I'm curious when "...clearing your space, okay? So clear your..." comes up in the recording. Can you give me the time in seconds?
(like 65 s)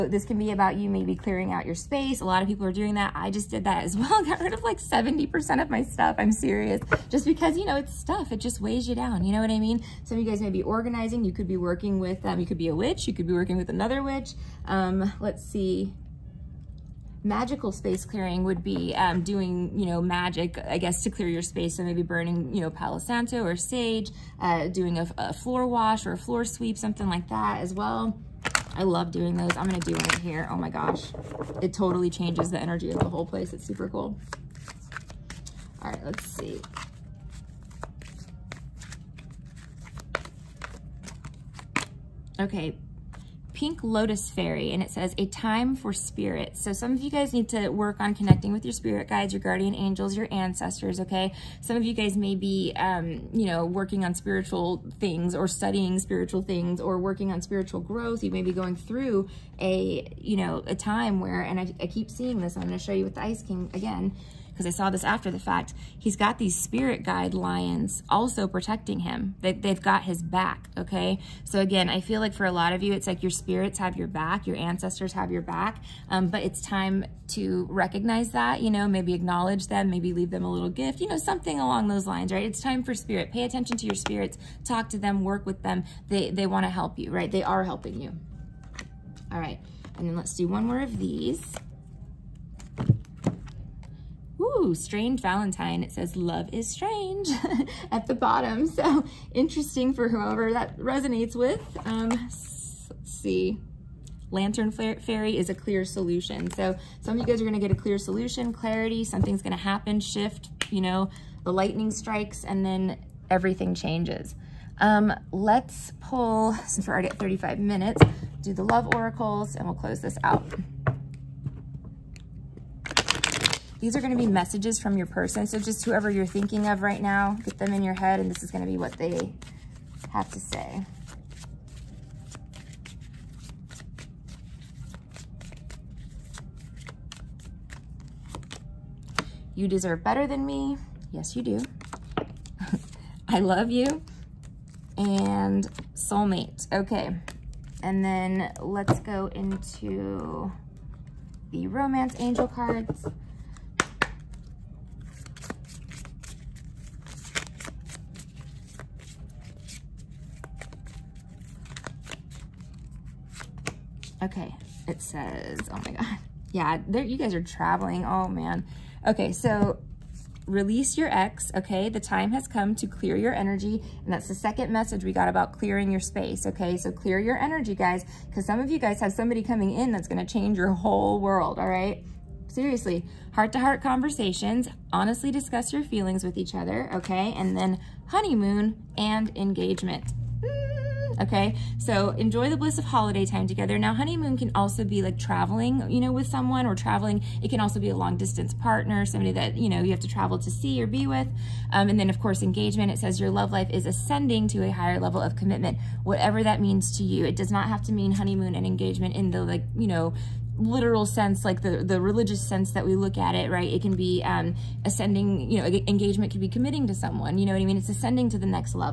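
175 s.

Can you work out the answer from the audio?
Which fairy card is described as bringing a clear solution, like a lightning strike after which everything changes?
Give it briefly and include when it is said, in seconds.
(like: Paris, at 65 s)
Lantern Fairy, at 104 s.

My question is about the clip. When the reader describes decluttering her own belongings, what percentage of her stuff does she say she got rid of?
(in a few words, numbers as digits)
70%.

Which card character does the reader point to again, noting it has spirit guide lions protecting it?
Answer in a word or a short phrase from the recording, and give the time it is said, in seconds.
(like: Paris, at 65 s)
Ice King, at 63 s.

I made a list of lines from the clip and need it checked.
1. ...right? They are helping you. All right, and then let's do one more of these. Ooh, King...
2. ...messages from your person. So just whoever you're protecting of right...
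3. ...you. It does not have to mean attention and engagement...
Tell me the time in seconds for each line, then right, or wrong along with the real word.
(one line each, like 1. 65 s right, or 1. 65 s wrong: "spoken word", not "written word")
1. 87 s wrong: "Strange", not "King"
2. 124 s wrong: "thinking", not "protecting"
3. 207 s wrong: "honeymoon", not "attention".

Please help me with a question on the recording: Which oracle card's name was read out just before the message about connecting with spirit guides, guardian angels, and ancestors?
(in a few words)
Pink Lotus Fairy.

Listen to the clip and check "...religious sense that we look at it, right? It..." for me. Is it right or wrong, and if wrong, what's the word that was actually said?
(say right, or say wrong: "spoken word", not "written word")
right.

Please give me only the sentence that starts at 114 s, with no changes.
Um, let's pull, since we're already at 35 minutes, do the love oracles, and we'll close this out.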